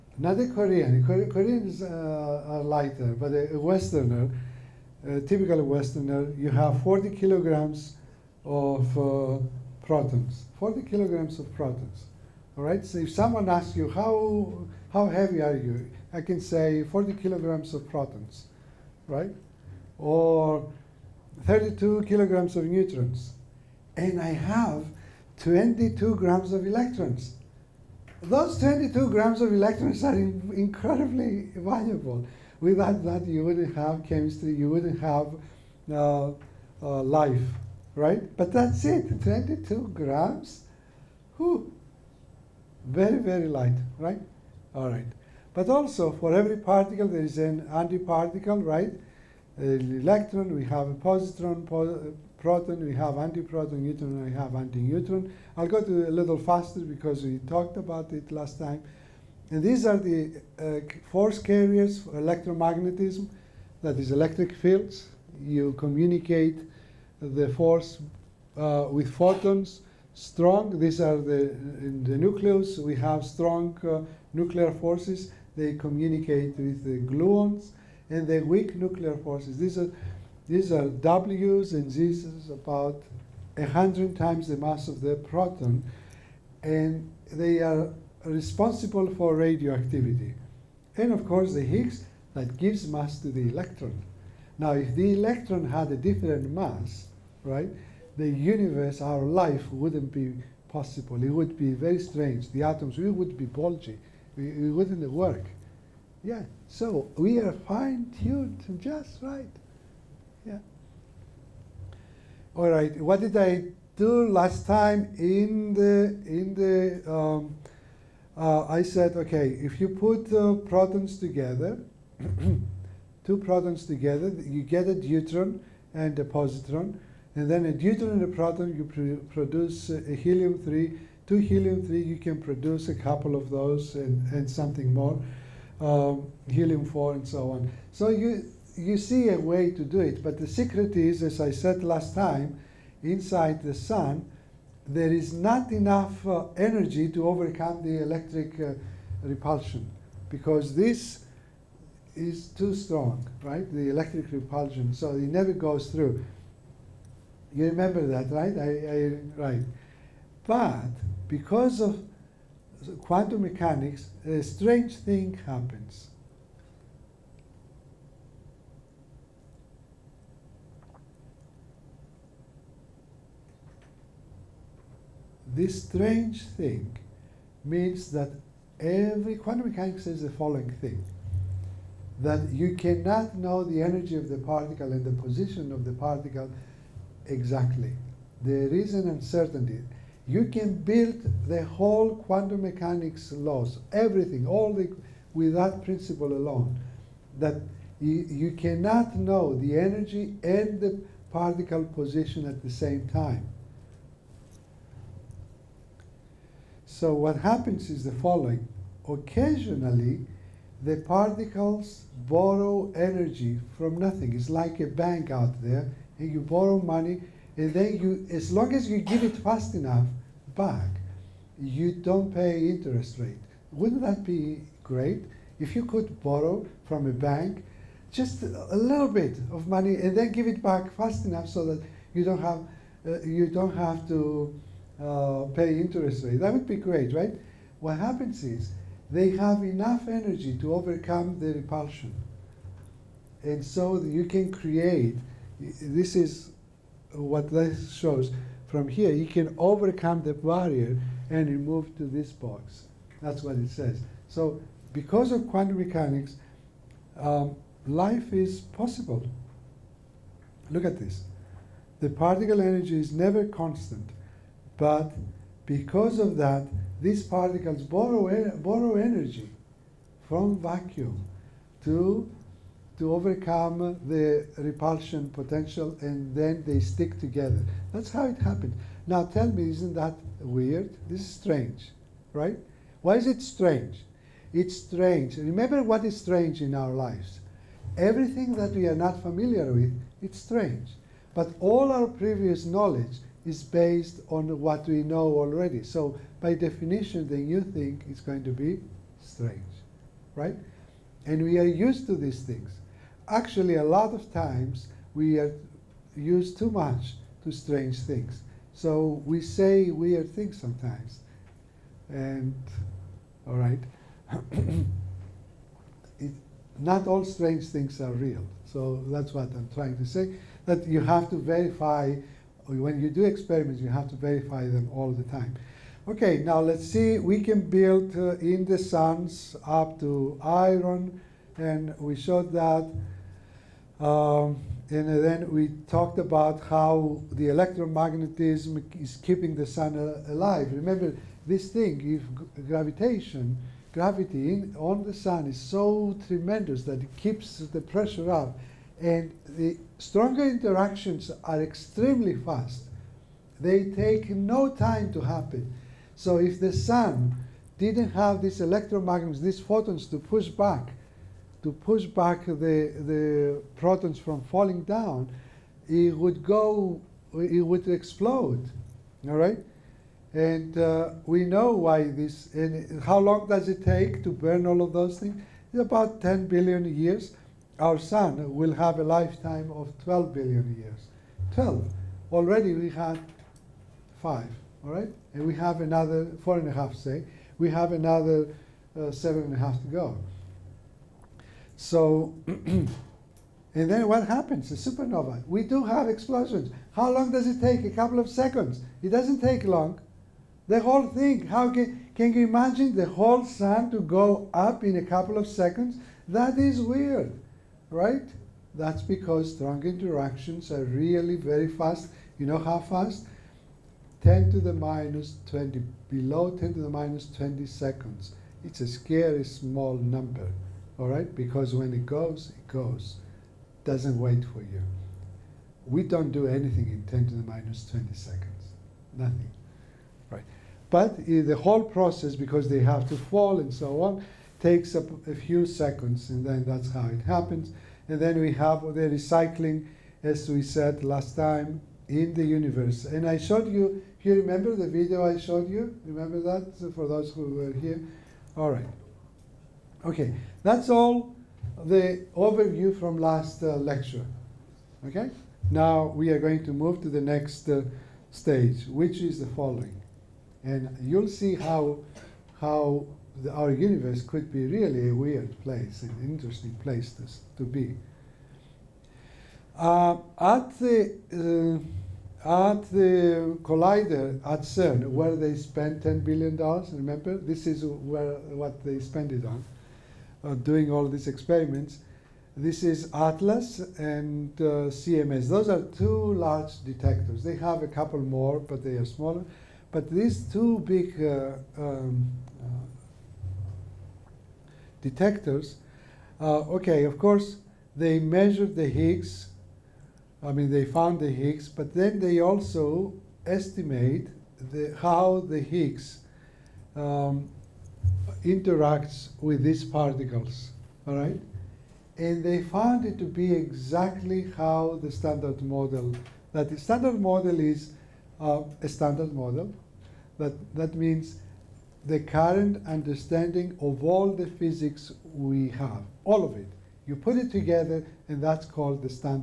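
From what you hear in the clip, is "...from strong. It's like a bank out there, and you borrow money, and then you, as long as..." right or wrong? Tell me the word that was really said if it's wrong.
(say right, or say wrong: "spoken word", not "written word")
wrong: "nothing", not "strong".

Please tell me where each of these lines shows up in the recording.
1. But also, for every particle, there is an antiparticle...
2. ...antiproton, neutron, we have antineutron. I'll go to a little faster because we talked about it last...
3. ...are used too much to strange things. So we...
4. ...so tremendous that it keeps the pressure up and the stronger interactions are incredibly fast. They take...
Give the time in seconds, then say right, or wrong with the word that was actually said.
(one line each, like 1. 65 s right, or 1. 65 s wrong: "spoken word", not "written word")
1. 45 s right
2. 53 s right
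3. 305 s right
4. 345 s wrong: "extremely", not "incredibly".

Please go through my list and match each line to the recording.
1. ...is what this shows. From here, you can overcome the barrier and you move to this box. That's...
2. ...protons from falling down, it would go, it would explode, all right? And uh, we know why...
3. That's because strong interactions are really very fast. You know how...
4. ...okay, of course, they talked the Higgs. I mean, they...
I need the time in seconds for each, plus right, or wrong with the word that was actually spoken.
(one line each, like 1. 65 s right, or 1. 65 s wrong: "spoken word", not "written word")
1. 246 s right
2. 363 s right
3. 408 s right
4. 496 s wrong: "measured", not "talked".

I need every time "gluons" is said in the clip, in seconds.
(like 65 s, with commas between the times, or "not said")
77 s.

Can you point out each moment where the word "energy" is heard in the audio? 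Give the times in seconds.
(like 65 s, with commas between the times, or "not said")
146 s, 183 s, 199 s, 212 s, 240 s, 262 s, 268 s.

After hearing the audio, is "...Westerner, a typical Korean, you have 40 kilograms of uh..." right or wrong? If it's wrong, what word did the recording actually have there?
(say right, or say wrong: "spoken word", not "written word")
wrong: "Westerner", not "Korean".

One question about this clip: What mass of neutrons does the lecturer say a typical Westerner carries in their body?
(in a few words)
32 kilograms.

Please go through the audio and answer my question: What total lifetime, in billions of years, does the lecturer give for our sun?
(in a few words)
12 billion years.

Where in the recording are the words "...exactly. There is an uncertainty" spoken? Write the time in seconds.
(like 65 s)
187 s.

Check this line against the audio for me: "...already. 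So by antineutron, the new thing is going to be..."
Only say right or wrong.
wrong.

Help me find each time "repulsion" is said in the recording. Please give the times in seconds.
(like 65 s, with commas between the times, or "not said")
149 s, 154 s, 241 s, 274 s.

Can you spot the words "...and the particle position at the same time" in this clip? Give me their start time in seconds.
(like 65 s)
200 s.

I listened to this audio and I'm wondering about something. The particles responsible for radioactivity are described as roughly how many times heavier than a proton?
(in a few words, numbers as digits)
100.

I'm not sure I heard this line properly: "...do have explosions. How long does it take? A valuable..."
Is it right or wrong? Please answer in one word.
wrong.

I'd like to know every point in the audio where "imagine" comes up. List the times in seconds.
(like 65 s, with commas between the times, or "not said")
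402 s.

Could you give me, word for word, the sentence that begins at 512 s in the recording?
And they found it to be exactly how the standard model, that the standard model is uh, a standard model.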